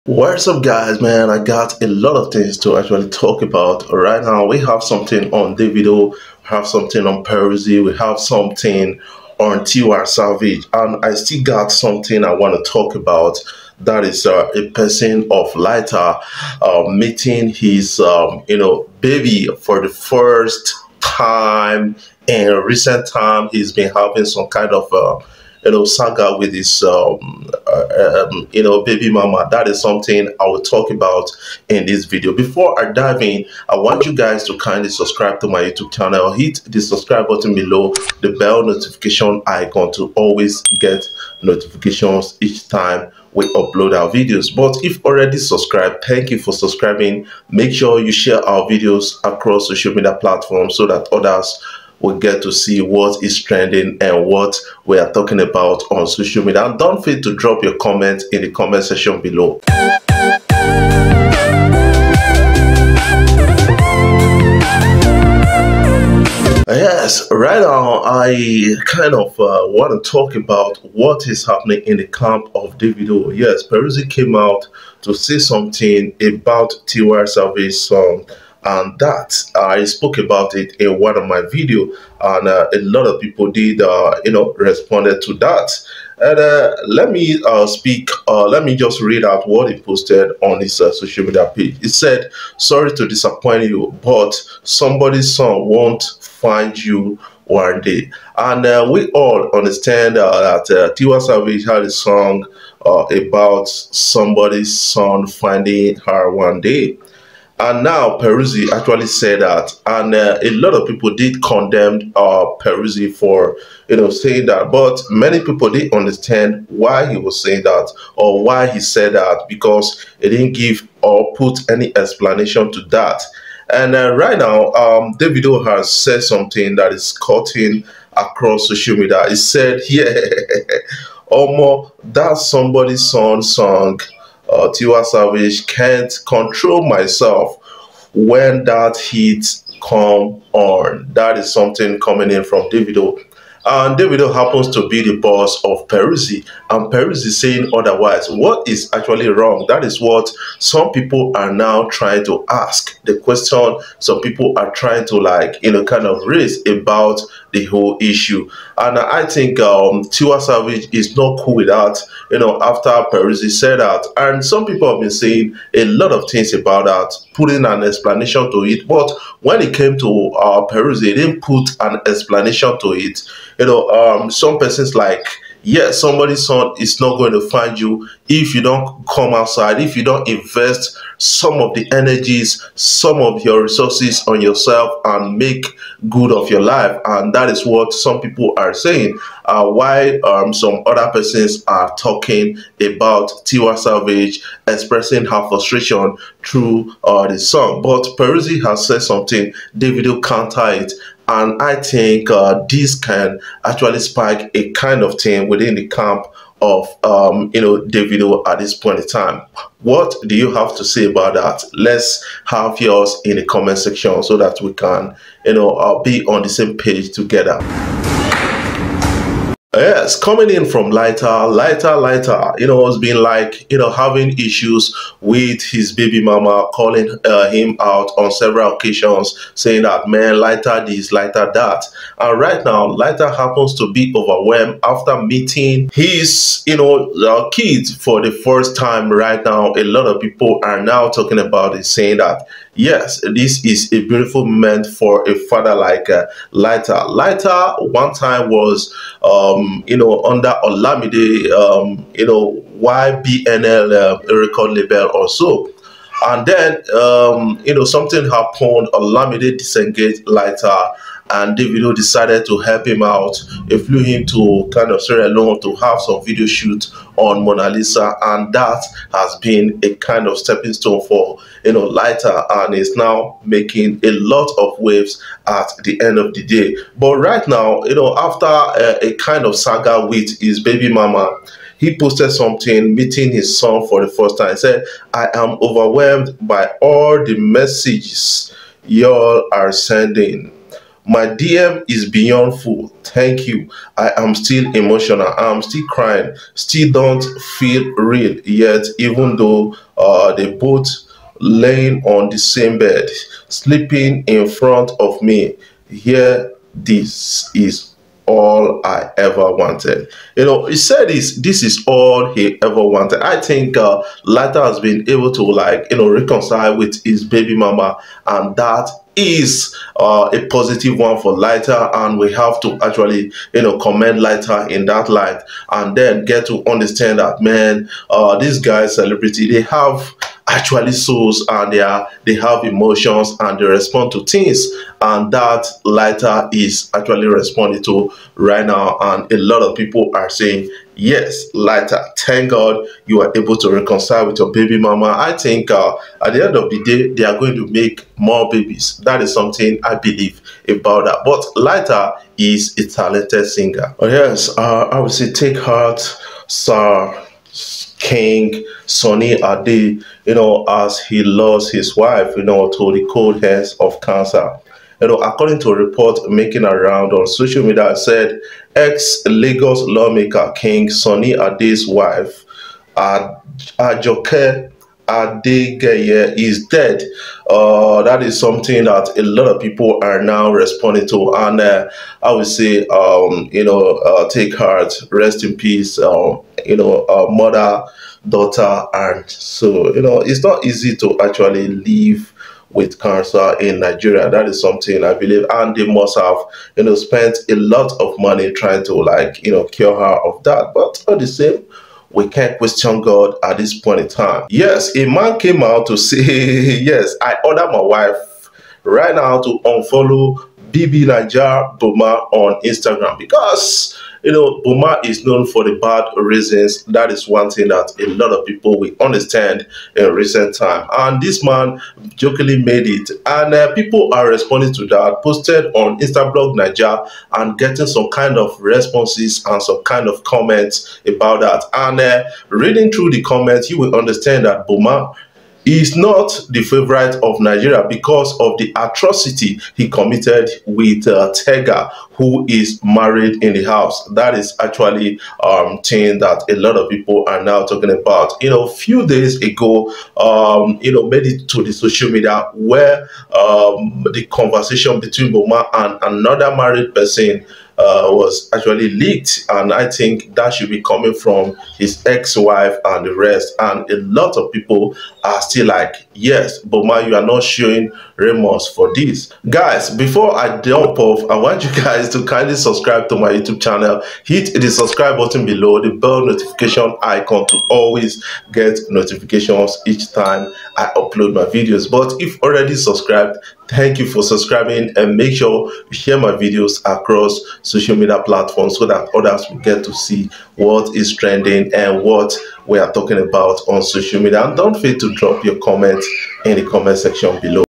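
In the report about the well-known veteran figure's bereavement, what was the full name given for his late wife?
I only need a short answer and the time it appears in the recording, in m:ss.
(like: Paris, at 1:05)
Ajoke Adegeye, at 6:12.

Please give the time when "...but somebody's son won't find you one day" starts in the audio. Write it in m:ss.
1:34.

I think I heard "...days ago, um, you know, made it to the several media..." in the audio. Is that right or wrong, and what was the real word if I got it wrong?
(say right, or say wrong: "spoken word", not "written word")
wrong: "social", not "several".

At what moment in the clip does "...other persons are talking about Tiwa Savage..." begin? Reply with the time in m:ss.
3:10.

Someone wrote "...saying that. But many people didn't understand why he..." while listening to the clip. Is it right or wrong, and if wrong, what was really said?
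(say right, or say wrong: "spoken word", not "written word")
right.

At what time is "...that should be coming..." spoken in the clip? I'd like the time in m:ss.
7:40.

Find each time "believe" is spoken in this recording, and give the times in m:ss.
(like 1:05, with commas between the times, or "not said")
5:49, 6:35.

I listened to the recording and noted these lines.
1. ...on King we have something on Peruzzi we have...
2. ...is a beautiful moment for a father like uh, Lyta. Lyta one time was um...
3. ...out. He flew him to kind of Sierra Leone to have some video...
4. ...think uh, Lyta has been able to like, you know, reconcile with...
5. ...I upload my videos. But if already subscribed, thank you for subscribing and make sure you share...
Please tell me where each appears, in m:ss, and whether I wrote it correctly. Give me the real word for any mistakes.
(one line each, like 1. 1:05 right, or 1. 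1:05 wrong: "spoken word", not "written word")
1. 0:05 wrong: "Davido", not "King"
2. 4:03 right
3. 4:23 right
4. 5:13 right
5. 8:00 right.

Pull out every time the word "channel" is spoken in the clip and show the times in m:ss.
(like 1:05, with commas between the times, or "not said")
0:35, 7:53.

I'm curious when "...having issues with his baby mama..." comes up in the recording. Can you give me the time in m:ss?
3:43.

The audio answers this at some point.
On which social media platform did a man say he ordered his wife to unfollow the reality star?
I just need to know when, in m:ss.
6:52.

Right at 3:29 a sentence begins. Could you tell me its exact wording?
What do you have to say about that?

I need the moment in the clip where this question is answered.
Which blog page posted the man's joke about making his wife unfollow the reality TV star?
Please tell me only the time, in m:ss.
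7:05.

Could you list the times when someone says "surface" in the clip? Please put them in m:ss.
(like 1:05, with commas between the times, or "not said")
not said.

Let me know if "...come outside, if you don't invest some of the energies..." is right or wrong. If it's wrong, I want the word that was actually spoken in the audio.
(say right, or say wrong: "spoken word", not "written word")
right.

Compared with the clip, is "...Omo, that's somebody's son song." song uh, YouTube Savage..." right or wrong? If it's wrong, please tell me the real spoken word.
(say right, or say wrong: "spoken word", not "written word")
wrong: "Tiwa", not "YouTube".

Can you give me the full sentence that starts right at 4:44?
He said, I am overwhelmed by all the messages y'all are sending.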